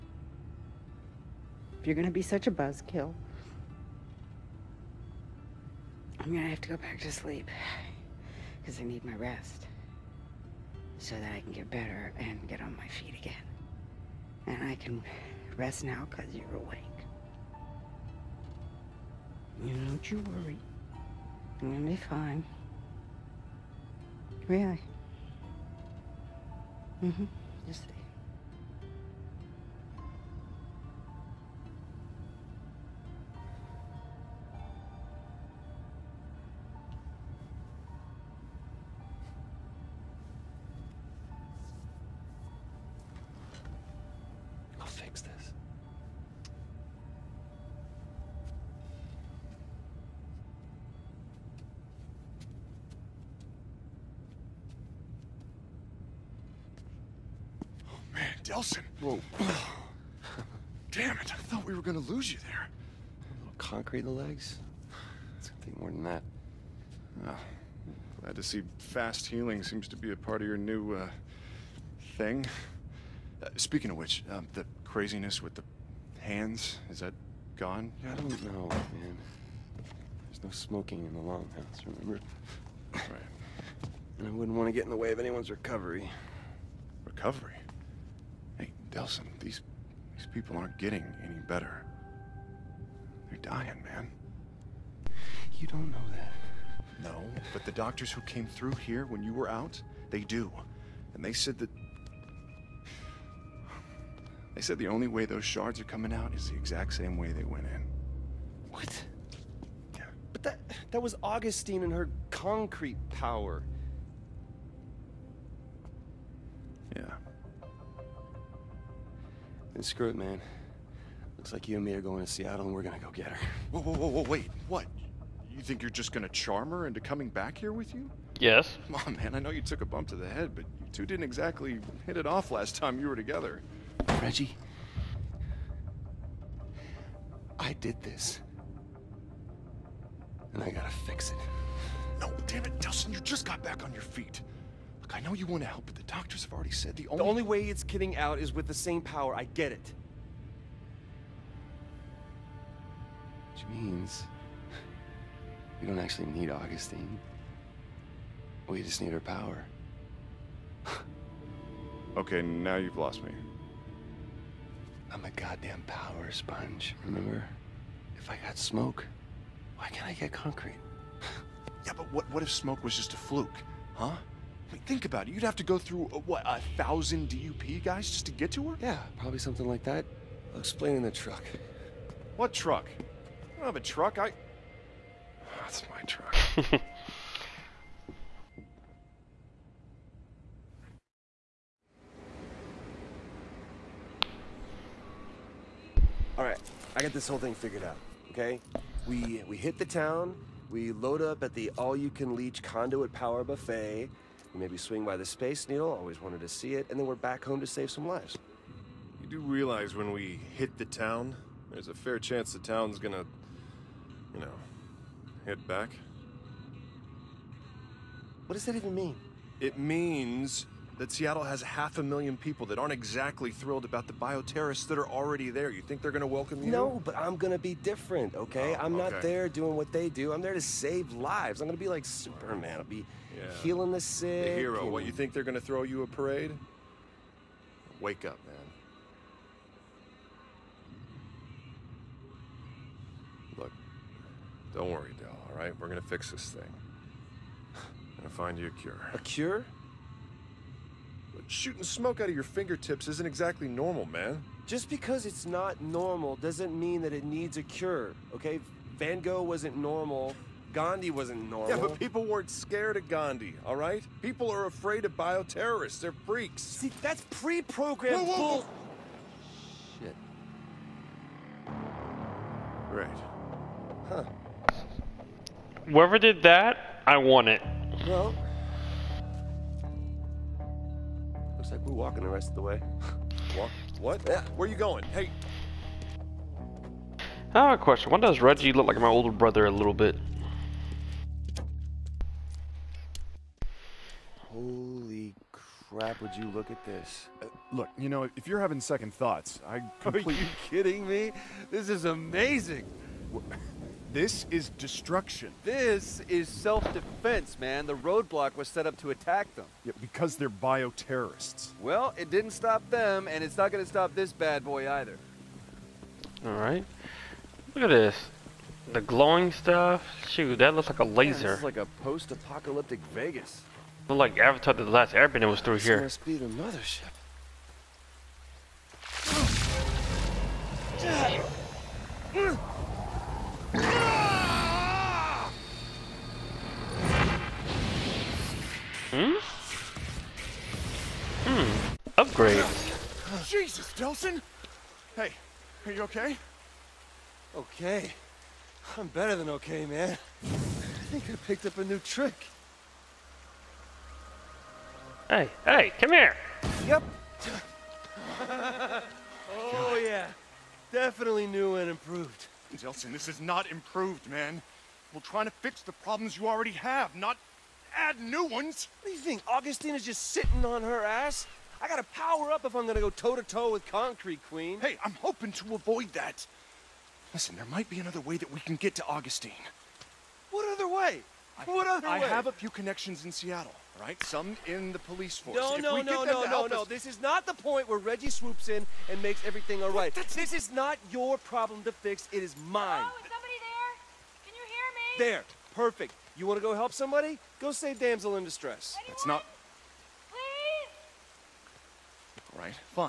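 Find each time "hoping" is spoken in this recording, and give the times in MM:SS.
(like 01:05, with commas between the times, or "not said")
06:15.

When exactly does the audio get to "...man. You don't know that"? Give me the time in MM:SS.
01:33.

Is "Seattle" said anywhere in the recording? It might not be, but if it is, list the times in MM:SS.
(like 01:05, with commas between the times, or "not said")
02:02, 03:41, 06:23.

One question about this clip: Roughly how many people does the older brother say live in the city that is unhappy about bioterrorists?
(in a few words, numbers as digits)
half a million.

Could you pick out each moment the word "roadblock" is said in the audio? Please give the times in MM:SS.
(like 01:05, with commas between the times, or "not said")
05:07.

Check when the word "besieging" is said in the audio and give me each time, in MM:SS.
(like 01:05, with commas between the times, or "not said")
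not said.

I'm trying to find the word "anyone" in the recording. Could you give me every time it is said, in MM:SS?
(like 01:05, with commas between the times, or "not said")
01:25, 06:38.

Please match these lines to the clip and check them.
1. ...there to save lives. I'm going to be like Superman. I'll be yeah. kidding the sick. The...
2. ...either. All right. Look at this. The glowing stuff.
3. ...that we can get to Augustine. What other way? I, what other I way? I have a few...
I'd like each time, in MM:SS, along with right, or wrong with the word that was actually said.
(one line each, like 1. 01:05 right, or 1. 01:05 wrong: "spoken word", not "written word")
1. 03:50 wrong: "healing", not "kidding"
2. 05:14 right
3. 06:18 right.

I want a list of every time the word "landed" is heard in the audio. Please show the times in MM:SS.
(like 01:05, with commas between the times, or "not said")
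not said.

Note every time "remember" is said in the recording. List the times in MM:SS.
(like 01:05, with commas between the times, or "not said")
01:21, 02:47.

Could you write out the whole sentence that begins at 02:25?
Look, I know you want to help, but the doctors have already said the only...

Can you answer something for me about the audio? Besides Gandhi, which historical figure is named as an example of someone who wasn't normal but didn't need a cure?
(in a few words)
Van Gogh.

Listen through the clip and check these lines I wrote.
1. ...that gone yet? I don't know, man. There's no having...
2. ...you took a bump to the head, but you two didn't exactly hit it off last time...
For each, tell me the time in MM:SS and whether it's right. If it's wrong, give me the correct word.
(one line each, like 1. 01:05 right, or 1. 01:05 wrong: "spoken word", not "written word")
1. 01:16 wrong: "smoking", not "having"
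2. 02:09 right.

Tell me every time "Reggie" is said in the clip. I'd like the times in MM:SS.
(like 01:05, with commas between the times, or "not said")
02:14, 04:48, 06:27.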